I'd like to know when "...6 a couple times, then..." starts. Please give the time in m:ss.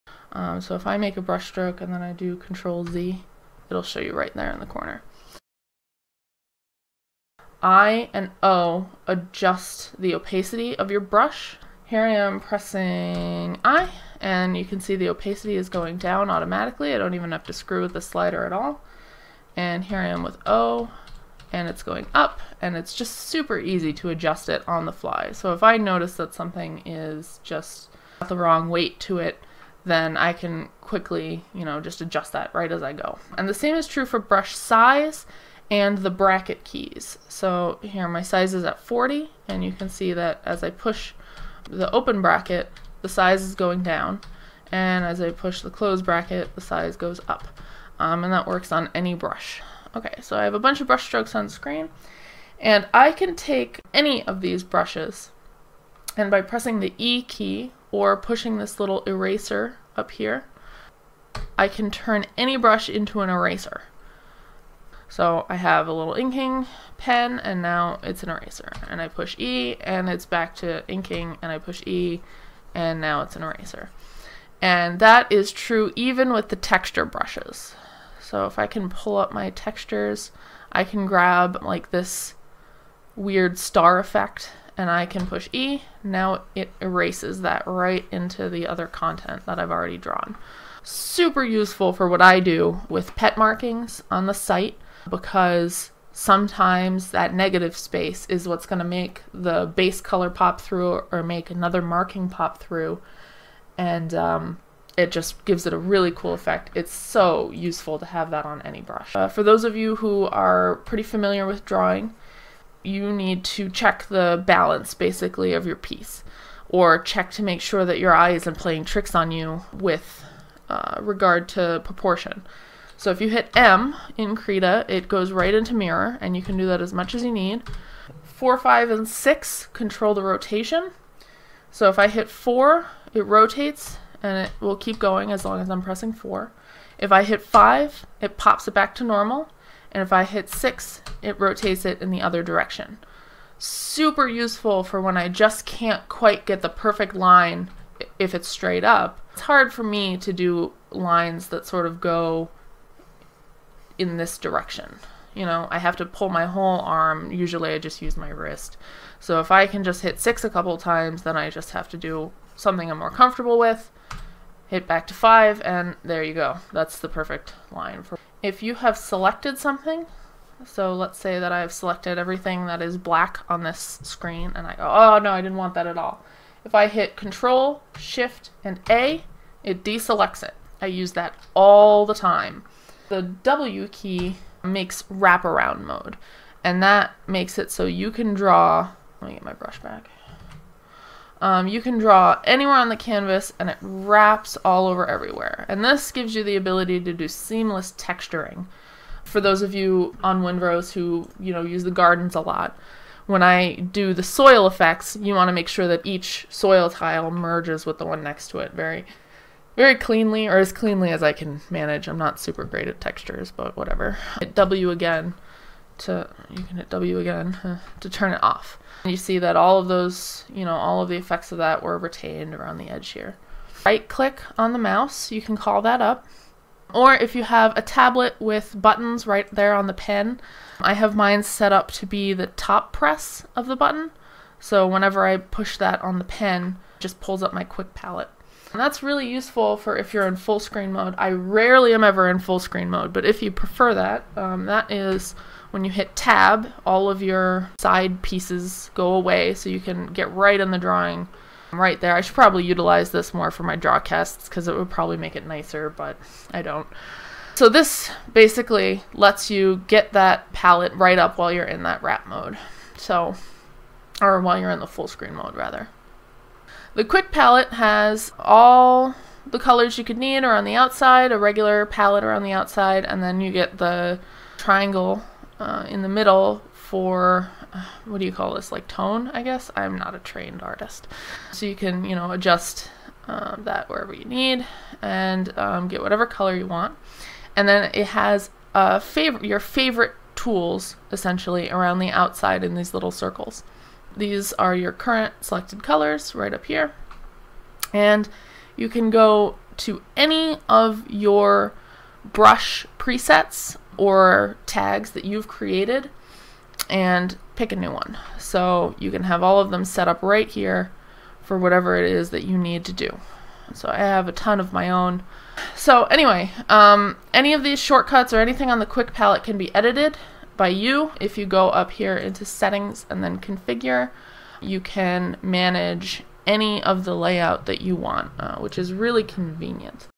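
2:40.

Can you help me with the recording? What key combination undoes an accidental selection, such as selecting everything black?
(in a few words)
Control, Shift, and A.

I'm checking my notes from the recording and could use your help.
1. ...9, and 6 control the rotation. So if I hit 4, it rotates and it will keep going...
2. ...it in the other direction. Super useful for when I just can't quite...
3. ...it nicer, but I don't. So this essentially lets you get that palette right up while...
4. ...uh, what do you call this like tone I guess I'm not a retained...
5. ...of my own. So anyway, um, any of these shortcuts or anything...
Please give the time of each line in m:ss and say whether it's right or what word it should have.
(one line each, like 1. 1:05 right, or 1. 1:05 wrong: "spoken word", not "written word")
1. 2:08 wrong: "5", not "9"
2. 2:21 right
3. 4:15 wrong: "basically", not "essentially"
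4. 4:37 wrong: "trained", not "retained"
5. 5:14 right.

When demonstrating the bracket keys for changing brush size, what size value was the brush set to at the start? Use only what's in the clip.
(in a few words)
40.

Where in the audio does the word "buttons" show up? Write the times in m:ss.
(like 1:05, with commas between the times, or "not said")
3:48, 3:53.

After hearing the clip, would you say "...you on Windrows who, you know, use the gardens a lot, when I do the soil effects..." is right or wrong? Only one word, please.
right.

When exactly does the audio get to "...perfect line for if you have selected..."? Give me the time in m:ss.
2:47.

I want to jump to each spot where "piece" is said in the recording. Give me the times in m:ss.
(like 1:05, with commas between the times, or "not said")
1:55, 4:08.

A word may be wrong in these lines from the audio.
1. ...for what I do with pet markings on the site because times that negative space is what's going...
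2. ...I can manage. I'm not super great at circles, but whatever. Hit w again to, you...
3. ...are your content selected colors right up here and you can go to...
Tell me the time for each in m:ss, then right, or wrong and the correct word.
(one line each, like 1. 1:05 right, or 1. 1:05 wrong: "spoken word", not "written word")
1. 1:31 wrong: "sometimes", not "times"
2. 3:31 wrong: "textures", not "circles"
3. 4:54 wrong: "current", not "content".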